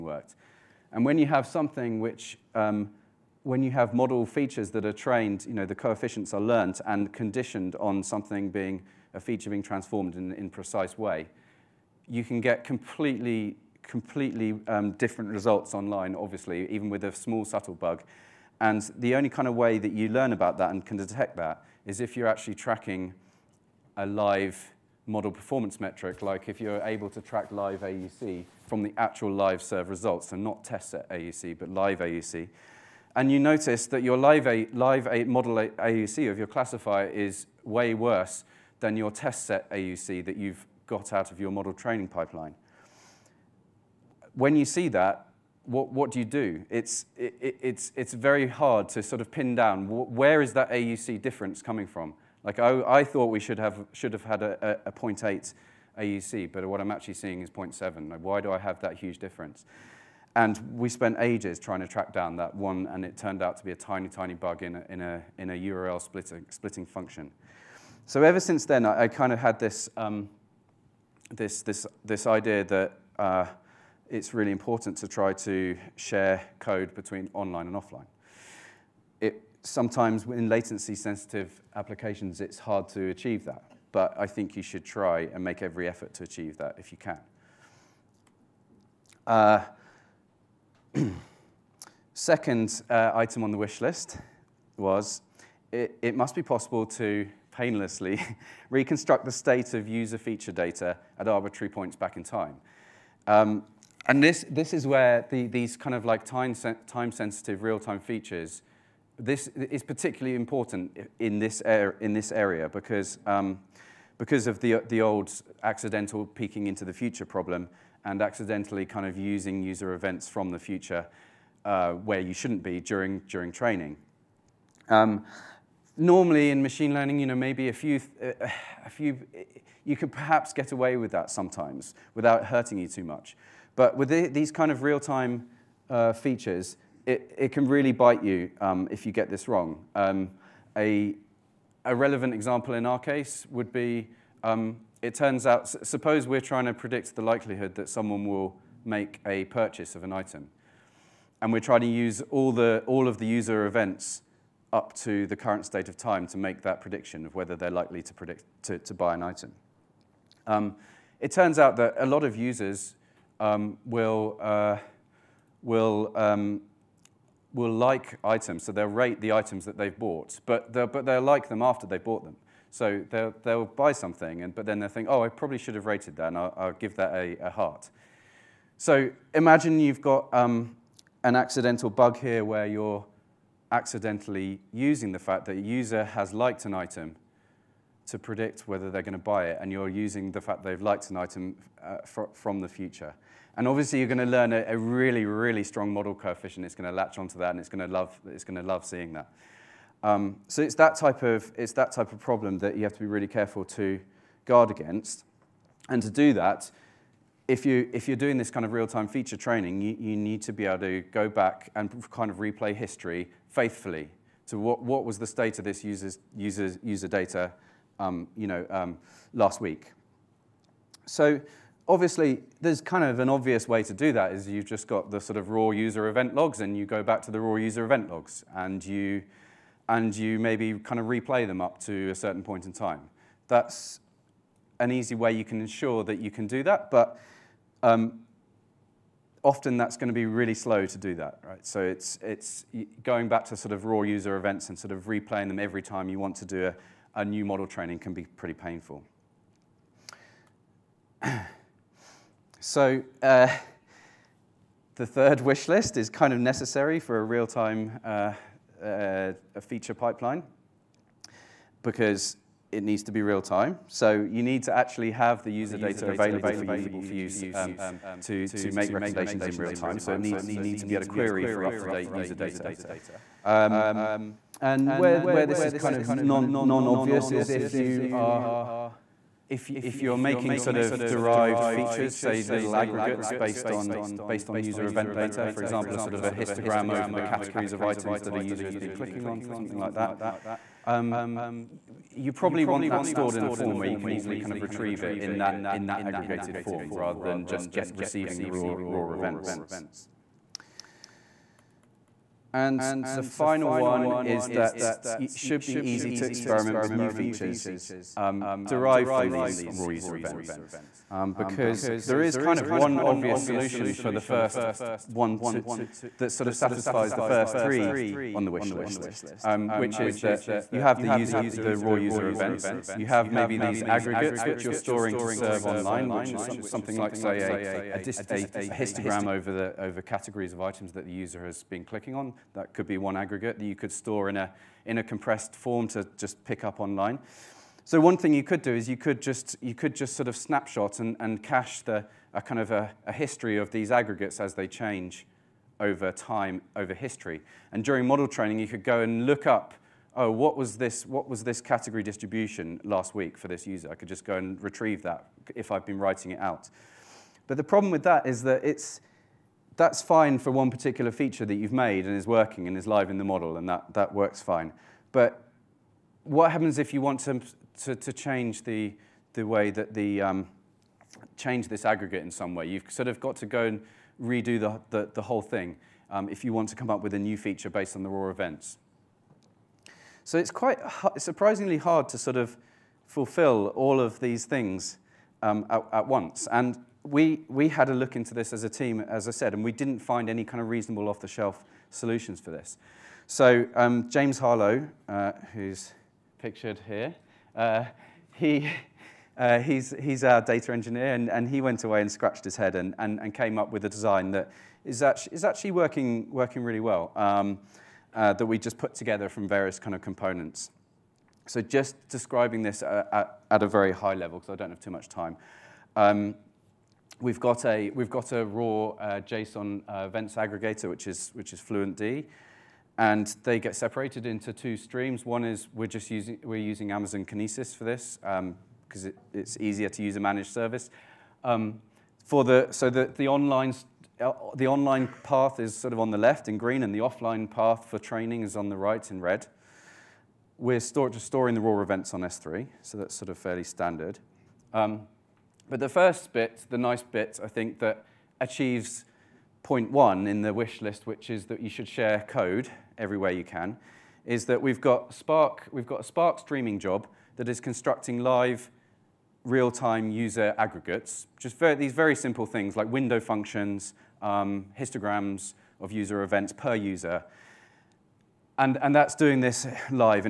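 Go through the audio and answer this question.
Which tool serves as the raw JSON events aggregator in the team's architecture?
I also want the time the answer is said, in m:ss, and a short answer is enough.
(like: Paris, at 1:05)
FluentD, at 7:01.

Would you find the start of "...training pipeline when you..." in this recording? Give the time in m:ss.
0:41.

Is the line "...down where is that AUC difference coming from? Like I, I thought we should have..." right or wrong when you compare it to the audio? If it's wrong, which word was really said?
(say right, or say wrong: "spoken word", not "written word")
right.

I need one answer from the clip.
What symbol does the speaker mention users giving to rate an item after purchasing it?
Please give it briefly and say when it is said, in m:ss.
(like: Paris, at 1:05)
A heart, at 2:57.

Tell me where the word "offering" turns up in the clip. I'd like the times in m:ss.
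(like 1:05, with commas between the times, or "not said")
not said.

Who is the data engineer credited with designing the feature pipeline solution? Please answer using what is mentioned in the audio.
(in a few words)
James Harlow.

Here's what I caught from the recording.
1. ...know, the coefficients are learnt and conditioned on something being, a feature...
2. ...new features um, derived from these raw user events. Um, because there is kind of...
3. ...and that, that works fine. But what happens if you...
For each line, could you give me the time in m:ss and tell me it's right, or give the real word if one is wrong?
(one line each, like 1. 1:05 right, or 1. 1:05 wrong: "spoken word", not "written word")
1. 0:05 right
2. 5:06 right
3. 6:03 right.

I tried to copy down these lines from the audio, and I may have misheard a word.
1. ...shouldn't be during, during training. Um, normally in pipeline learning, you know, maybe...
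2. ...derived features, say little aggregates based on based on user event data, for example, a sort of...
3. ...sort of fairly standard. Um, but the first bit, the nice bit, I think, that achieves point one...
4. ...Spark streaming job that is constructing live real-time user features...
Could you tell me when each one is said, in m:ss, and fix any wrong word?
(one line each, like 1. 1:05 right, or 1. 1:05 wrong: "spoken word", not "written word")
1. 2:02 wrong: "machine", not "pipeline"
2. 4:41 right
3. 7:23 right
4. 7:36 wrong: "aggregates", not "features".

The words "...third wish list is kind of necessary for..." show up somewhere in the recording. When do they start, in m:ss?
4:15.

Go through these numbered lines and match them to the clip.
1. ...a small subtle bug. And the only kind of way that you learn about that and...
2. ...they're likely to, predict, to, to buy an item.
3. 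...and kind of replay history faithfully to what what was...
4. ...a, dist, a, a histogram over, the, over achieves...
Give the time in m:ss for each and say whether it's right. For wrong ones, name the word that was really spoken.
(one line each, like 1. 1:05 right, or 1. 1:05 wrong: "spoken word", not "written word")
1. 0:17 right
2. 2:37 right
3. 3:31 right
4. 5:27 wrong: "categories", not "achieves".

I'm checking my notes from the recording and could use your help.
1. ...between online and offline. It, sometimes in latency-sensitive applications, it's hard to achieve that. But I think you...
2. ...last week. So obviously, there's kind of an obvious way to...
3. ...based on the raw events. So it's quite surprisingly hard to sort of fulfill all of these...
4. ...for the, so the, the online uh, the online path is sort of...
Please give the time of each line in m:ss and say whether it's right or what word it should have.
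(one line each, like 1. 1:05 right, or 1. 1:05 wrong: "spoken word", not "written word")
1. 1:16 right
2. 3:39 right
3. 6:17 right
4. 7:12 right.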